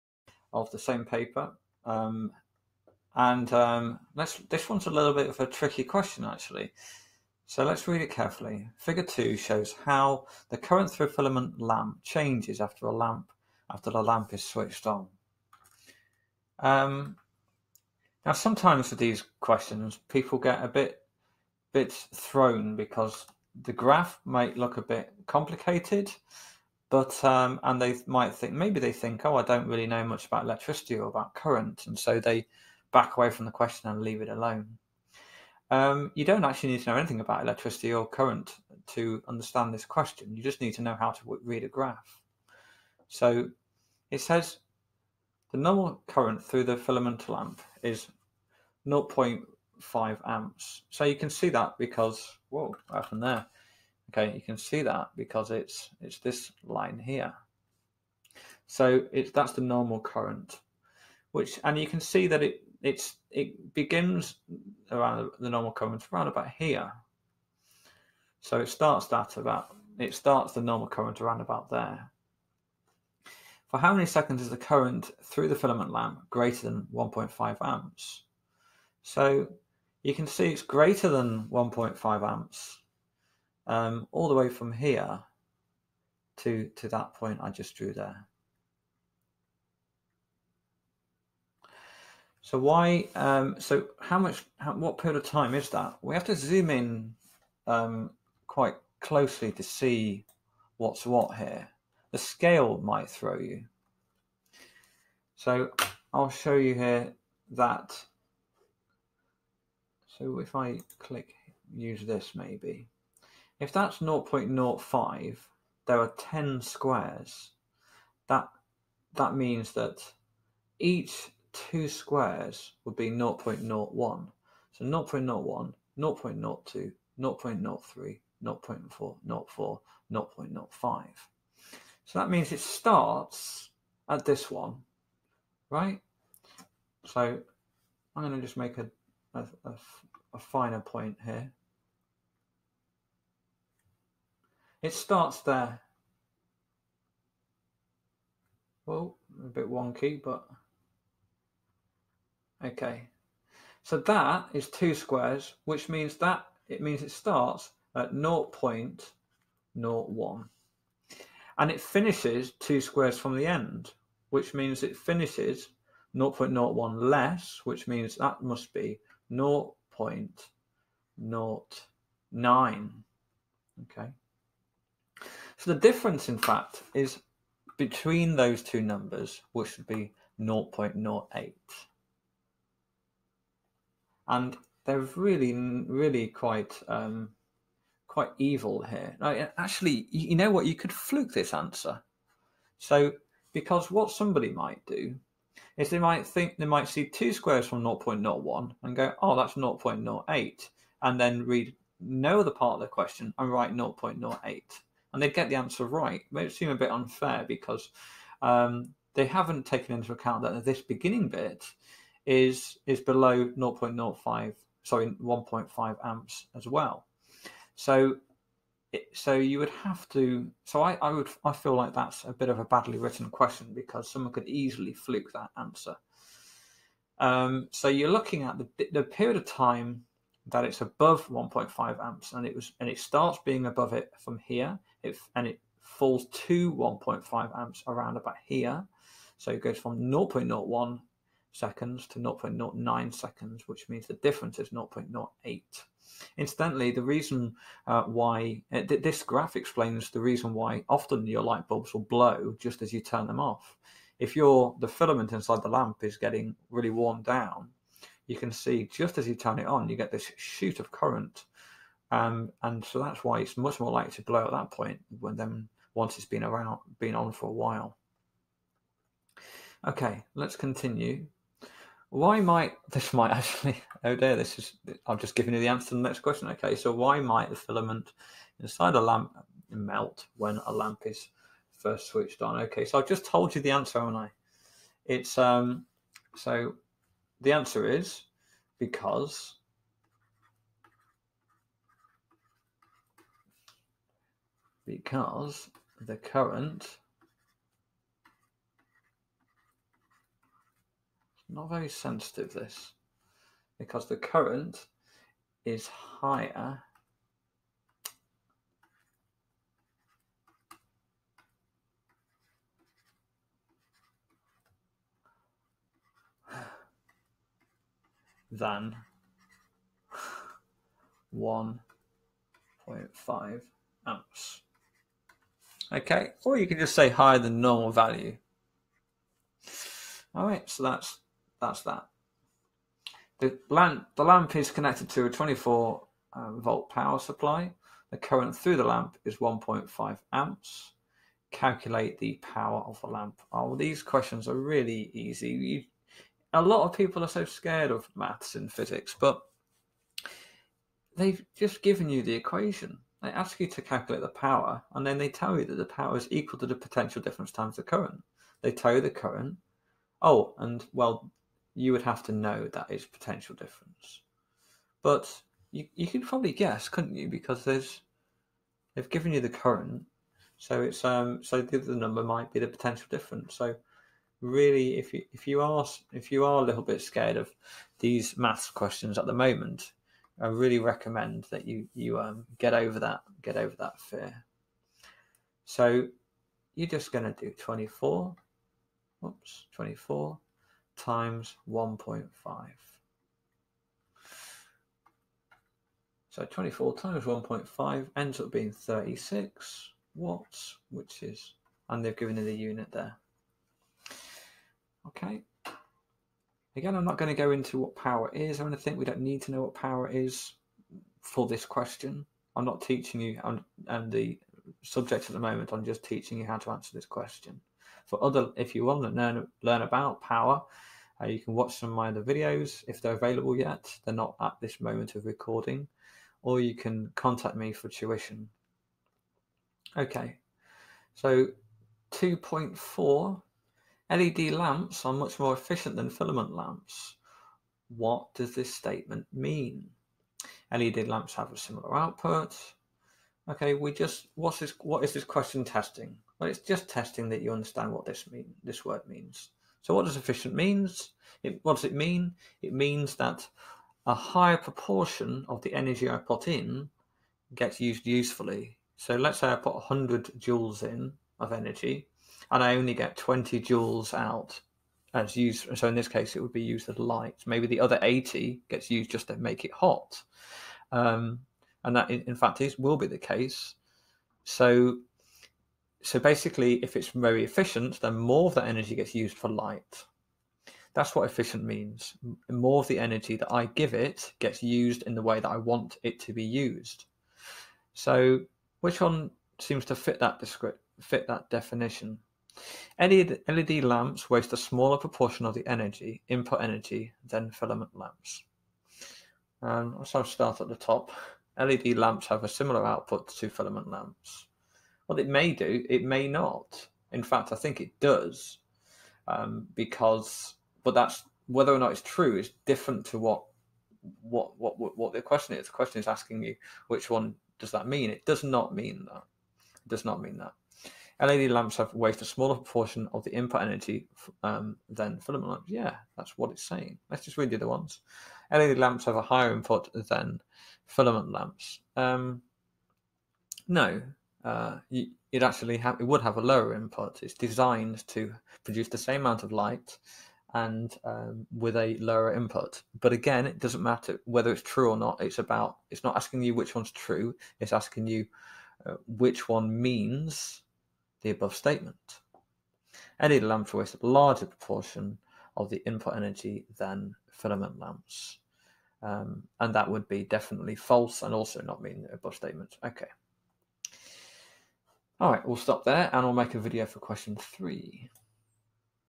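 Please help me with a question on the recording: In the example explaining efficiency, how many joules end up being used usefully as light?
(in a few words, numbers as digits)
20.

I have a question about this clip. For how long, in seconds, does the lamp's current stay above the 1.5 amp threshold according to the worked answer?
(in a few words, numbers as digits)
0.08.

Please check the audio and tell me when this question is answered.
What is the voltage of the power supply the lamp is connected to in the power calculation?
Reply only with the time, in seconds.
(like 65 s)
335 s.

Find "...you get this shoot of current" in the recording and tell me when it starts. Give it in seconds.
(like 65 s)
259 s.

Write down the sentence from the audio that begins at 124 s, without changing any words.
So 0.01, 0.02, 0.03, 0.04, 0.04, 0.05.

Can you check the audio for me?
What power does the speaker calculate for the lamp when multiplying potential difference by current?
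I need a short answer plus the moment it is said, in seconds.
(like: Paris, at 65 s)
36 watts, at 398 s.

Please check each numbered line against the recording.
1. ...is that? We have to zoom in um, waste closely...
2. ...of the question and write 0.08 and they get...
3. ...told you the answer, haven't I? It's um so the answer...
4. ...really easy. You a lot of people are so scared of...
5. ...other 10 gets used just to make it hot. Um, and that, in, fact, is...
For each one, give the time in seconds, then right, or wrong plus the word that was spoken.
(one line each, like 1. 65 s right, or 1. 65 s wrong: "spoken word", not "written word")
1. 95 s wrong: "quite", not "waste"
2. 202 s right
3. 283 s right
4. 344 s right
5. 467 s wrong: "80", not "10".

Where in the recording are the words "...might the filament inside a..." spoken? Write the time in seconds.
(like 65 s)
277 s.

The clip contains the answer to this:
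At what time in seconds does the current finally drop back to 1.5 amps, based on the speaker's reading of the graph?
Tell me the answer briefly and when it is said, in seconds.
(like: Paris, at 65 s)
0.09, at 167 s.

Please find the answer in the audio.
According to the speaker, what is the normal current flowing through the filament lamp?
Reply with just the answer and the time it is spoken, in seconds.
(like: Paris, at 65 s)
0.5 amps, at 48 s.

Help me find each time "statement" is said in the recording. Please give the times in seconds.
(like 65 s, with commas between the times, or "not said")
438 s, 551 s, 562 s.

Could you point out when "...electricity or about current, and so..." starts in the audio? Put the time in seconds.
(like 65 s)
30 s.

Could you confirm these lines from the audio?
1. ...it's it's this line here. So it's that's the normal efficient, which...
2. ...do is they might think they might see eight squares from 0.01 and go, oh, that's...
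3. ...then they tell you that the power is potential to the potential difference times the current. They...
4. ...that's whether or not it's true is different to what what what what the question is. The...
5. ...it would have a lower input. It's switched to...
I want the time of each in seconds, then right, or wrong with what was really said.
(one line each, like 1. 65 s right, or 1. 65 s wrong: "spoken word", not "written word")
1. 55 s wrong: "current", not "efficient"
2. 194 s wrong: "two", not "eight"
3. 355 s wrong: "equal", not "potential"
4. 510 s right
5. 535 s wrong: "designed", not "switched".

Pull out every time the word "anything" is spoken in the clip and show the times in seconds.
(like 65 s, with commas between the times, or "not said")
36 s, 408 s.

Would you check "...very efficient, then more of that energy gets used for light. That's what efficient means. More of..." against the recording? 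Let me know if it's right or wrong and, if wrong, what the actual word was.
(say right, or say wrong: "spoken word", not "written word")
right.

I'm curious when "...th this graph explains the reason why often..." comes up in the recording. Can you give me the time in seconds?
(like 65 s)
248 s.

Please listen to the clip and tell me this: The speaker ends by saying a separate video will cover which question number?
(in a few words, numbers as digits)
3.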